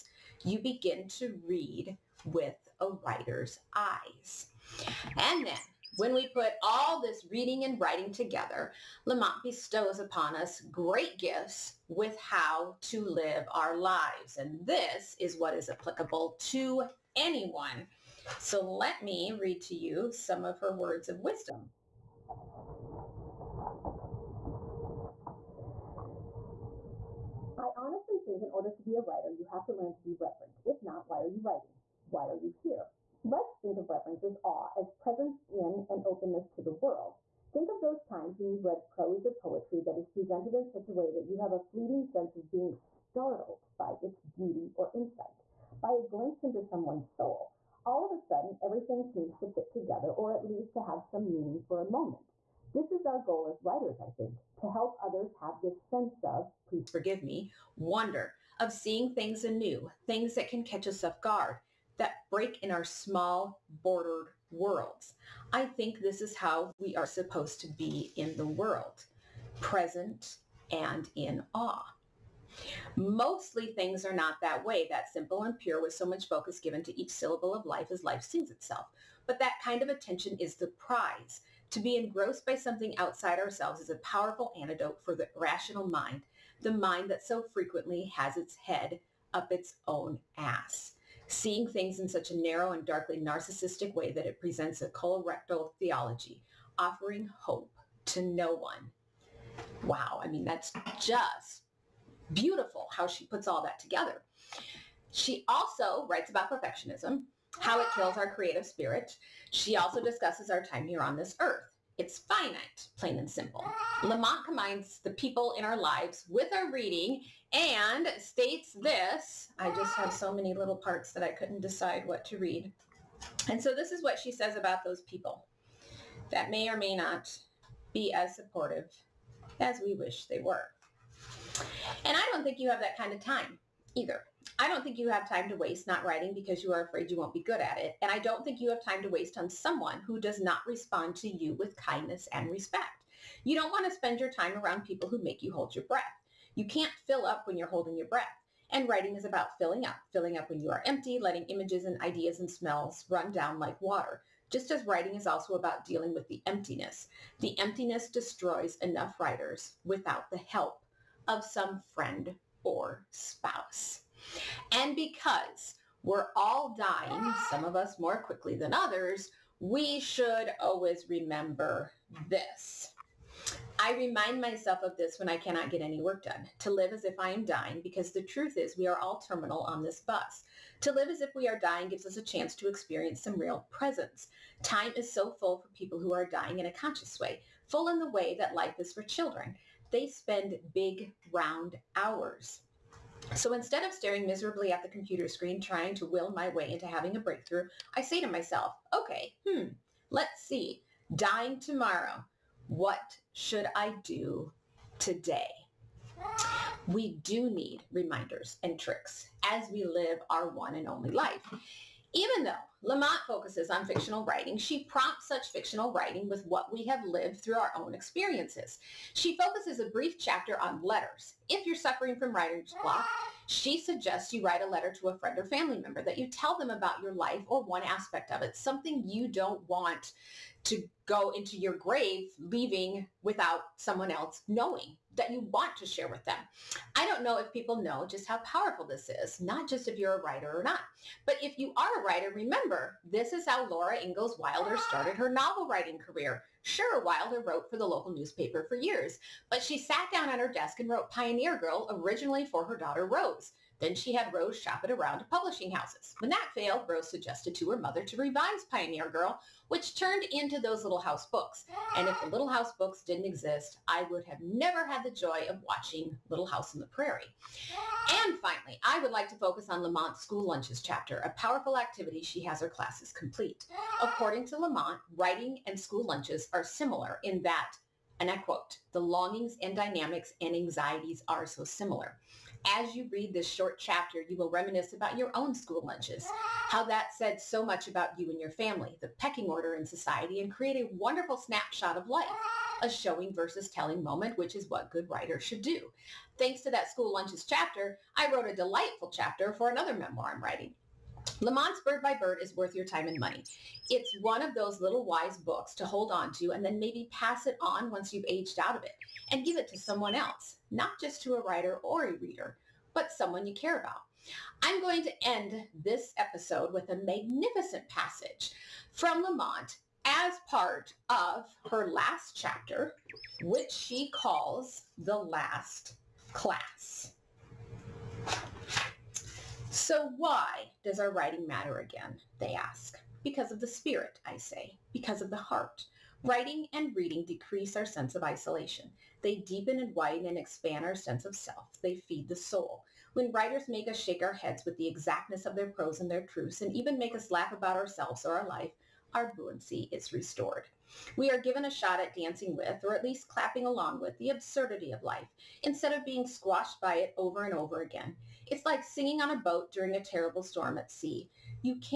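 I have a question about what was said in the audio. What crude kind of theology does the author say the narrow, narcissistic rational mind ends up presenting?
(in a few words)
Colorectal theology.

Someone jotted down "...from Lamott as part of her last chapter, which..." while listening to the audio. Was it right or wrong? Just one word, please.
right.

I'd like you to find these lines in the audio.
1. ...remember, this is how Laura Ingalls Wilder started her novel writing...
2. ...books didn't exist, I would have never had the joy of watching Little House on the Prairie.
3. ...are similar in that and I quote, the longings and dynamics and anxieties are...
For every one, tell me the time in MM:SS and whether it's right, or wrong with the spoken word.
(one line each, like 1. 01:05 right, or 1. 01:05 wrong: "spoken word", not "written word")
1. 04:02 right
2. 04:22 right
3. 04:36 right.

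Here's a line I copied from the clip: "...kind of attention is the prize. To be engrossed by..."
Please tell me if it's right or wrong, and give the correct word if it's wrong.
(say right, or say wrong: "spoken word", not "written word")
right.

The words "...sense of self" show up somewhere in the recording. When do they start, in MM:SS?
05:40.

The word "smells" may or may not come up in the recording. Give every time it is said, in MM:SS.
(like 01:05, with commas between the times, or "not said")
02:32.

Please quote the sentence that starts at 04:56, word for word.
Thanks to that school lunches chapter, I wrote a delightful chapter for another memoir I'm writing.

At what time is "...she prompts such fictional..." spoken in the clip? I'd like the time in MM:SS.
03:34.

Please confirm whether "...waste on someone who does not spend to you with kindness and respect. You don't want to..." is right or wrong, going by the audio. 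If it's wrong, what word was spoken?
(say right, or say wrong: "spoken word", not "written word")
wrong: "respond", not "spend".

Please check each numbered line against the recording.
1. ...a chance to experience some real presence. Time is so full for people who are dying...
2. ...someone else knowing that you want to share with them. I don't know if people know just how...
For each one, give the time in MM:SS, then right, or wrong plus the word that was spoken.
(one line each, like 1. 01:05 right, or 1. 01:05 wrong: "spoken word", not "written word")
1. 03:02 right
2. 03:53 right.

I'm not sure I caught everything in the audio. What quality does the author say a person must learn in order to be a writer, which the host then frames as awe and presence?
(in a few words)
Reverent.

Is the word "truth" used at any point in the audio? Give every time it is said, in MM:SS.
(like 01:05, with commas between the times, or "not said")
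02:58, 05:46.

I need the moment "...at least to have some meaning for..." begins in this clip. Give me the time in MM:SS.
00:50.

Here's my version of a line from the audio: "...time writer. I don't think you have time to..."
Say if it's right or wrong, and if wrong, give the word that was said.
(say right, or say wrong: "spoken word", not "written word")
wrong: "either", not "writer".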